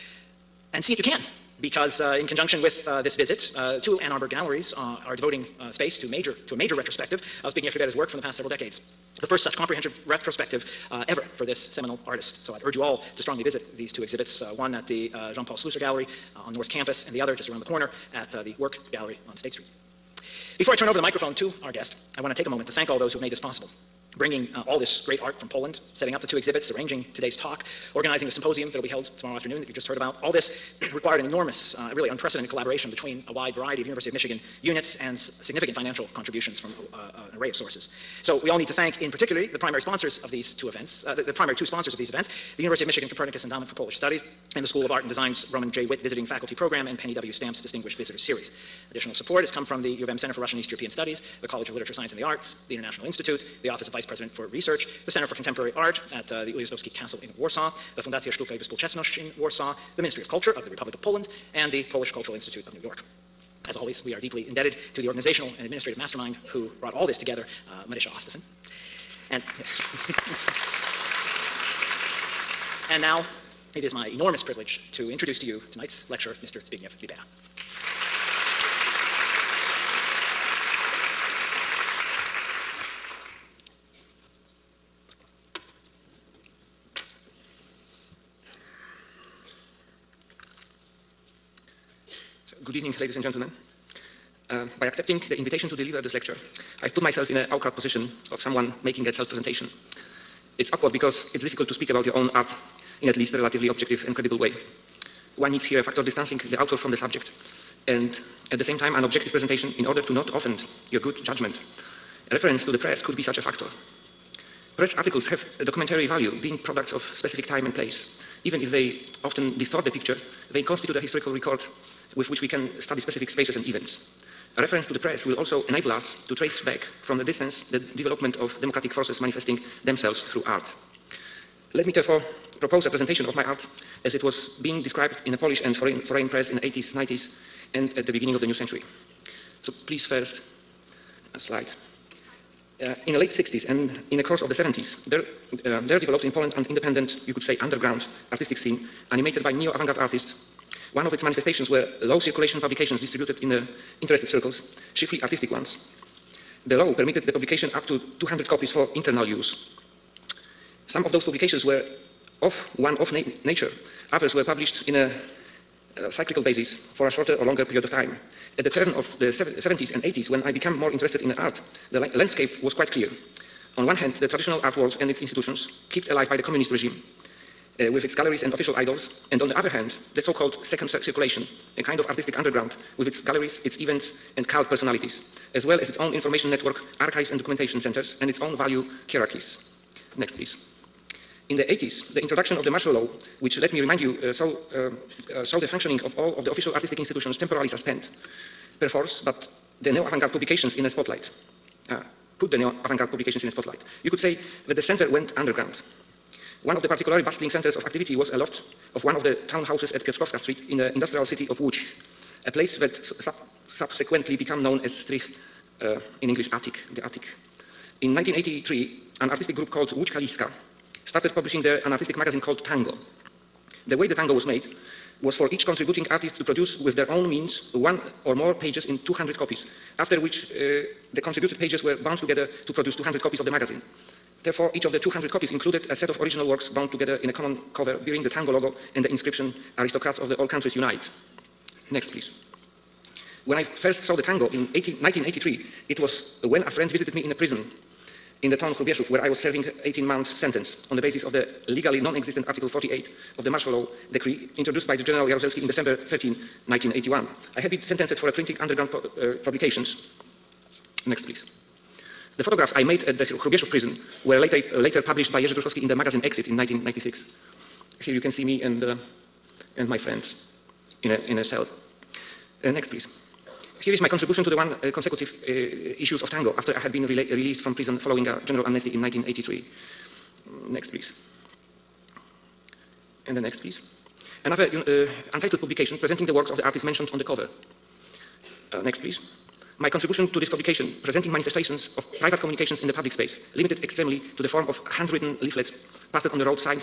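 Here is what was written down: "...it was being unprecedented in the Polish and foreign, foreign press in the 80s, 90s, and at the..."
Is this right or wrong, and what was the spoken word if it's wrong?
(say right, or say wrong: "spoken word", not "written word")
wrong: "described", not "unprecedented".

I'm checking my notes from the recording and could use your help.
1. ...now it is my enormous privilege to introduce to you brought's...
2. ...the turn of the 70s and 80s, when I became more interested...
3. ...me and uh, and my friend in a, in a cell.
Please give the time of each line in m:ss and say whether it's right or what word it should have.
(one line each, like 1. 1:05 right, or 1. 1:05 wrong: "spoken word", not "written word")
1. 1:13 wrong: "tonight", not "brought"
2. 2:48 right
3. 4:28 right.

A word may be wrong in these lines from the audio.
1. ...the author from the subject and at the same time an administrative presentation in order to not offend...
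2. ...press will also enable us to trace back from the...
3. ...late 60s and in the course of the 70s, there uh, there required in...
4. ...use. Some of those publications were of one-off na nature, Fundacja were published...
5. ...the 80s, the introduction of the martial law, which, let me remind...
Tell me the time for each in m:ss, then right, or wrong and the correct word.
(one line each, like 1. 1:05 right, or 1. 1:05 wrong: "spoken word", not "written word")
1. 1:46 wrong: "objective", not "administrative"
2. 2:04 right
3. 2:23 wrong: "developed", not "required"
4. 2:39 wrong: "Others", not "Fundacja"
5. 3:11 right.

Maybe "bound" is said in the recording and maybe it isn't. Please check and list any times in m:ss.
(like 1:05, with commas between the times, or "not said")
3:52, 3:56.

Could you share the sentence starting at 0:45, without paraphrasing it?
Witt Visiting Faculty Program and Penny W.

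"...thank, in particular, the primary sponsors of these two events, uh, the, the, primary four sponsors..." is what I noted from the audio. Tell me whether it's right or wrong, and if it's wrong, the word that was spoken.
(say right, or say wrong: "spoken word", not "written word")
wrong: "two", not "four".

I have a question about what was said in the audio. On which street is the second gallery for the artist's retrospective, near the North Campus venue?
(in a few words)
State Street.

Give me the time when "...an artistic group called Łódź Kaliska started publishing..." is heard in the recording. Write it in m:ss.
3:39.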